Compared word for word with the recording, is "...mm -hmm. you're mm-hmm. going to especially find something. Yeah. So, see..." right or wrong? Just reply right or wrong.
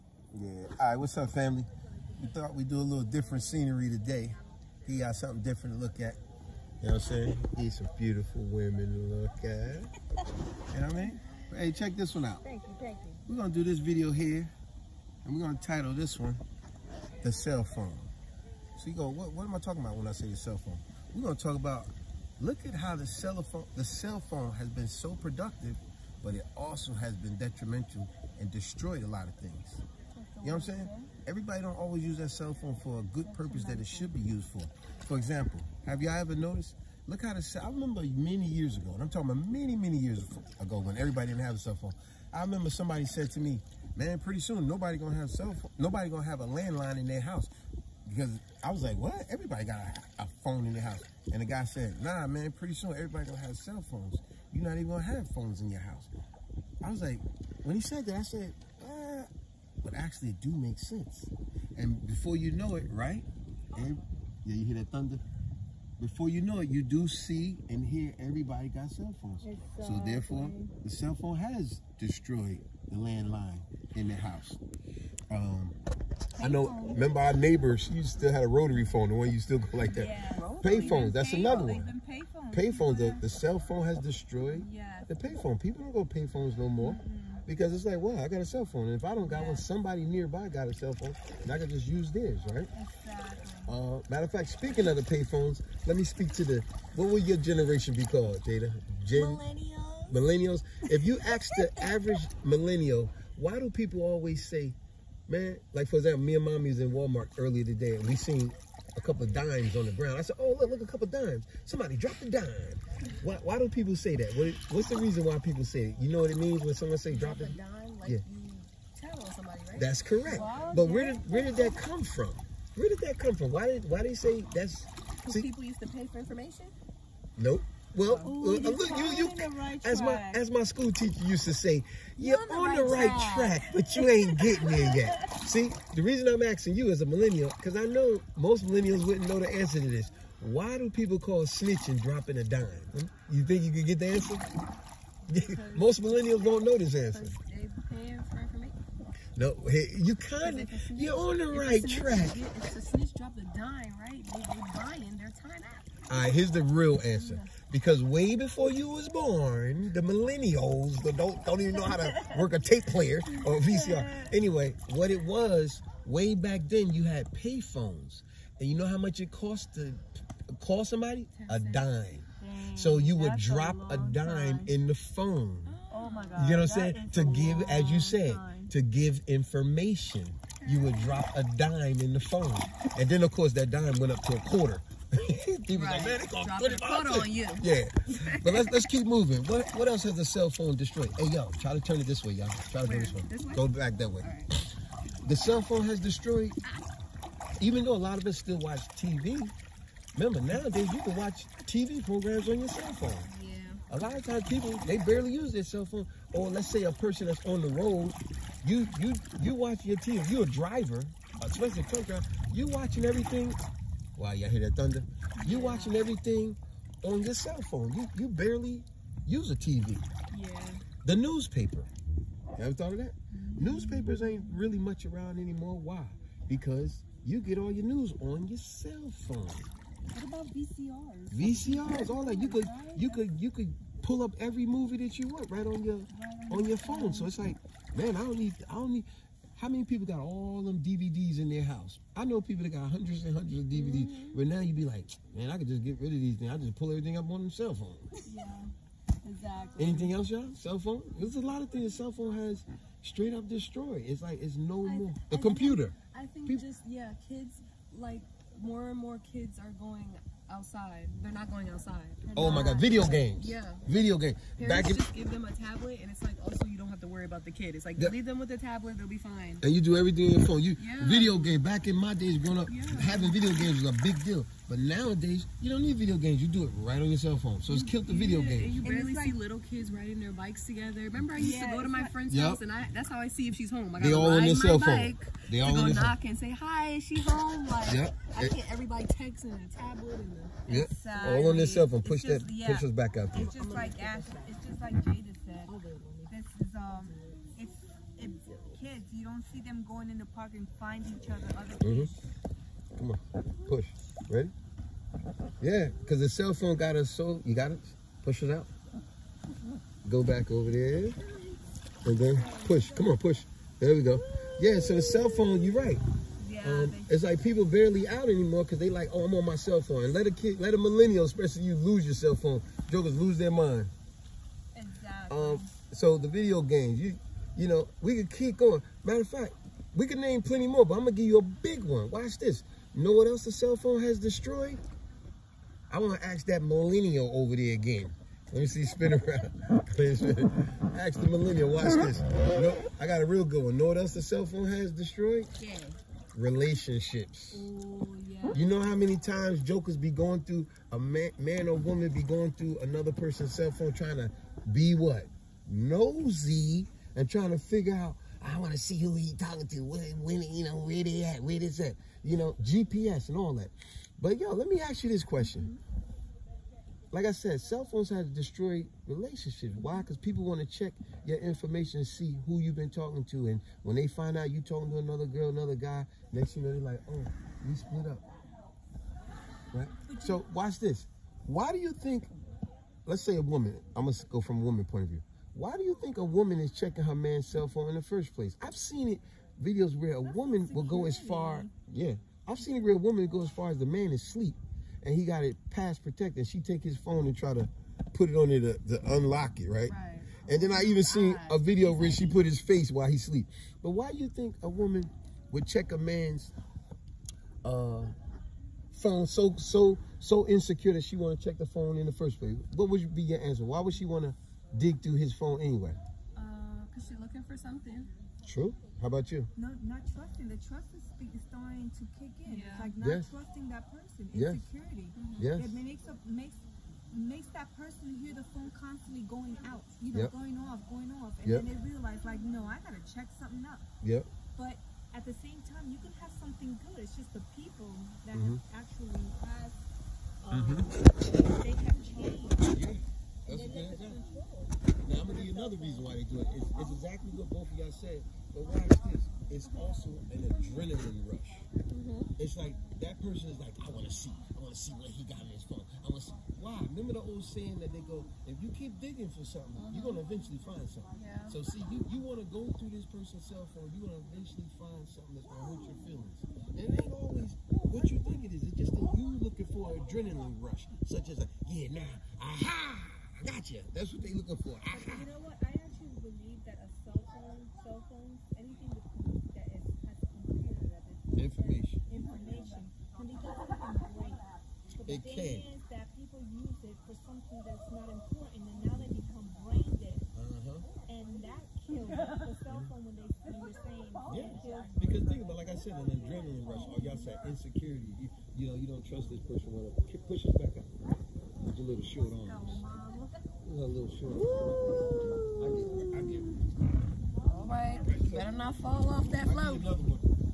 wrong.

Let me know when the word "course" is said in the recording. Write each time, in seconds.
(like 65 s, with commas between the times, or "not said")
183 s.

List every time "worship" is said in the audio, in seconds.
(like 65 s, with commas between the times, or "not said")
not said.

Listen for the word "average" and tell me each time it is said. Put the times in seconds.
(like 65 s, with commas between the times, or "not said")
101 s.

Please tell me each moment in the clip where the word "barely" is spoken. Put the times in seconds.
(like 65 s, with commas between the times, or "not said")
204 s, 218 s, 278 s, 317 s.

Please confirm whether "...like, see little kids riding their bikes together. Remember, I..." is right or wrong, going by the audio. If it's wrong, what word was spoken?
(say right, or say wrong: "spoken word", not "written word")
right.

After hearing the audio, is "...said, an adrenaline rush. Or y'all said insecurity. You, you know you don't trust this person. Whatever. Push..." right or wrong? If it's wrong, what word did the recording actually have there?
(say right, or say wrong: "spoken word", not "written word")
right.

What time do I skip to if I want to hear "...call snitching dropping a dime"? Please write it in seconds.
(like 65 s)
141 s.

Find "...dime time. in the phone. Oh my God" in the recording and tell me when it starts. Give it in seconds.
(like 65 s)
173 s.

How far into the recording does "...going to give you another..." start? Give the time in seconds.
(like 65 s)
445 s.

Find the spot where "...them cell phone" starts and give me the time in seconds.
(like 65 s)
247 s.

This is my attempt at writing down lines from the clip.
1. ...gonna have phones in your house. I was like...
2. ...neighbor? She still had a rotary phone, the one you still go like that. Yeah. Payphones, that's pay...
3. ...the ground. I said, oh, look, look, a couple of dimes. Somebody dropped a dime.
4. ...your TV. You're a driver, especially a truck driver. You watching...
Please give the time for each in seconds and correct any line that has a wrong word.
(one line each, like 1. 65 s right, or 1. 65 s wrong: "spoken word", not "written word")
1. 54 s right
2. 77 s right
3. 109 s right
4. 209 s right.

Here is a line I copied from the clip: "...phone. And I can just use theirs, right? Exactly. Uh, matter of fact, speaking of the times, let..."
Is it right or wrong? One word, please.
wrong.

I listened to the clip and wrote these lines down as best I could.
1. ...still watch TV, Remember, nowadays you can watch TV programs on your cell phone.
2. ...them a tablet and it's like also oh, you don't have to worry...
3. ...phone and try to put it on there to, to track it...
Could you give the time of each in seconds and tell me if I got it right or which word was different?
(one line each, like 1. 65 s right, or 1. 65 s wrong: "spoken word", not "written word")
1. 198 s right
2. 265 s right
3. 396 s wrong: "unlock", not "track".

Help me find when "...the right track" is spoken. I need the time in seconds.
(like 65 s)
151 s.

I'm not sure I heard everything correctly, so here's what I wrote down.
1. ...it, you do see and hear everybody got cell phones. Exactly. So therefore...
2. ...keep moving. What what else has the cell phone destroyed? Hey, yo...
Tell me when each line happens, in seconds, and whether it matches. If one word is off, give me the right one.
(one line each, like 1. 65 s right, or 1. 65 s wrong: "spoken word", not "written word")
1. 66 s right
2. 188 s right.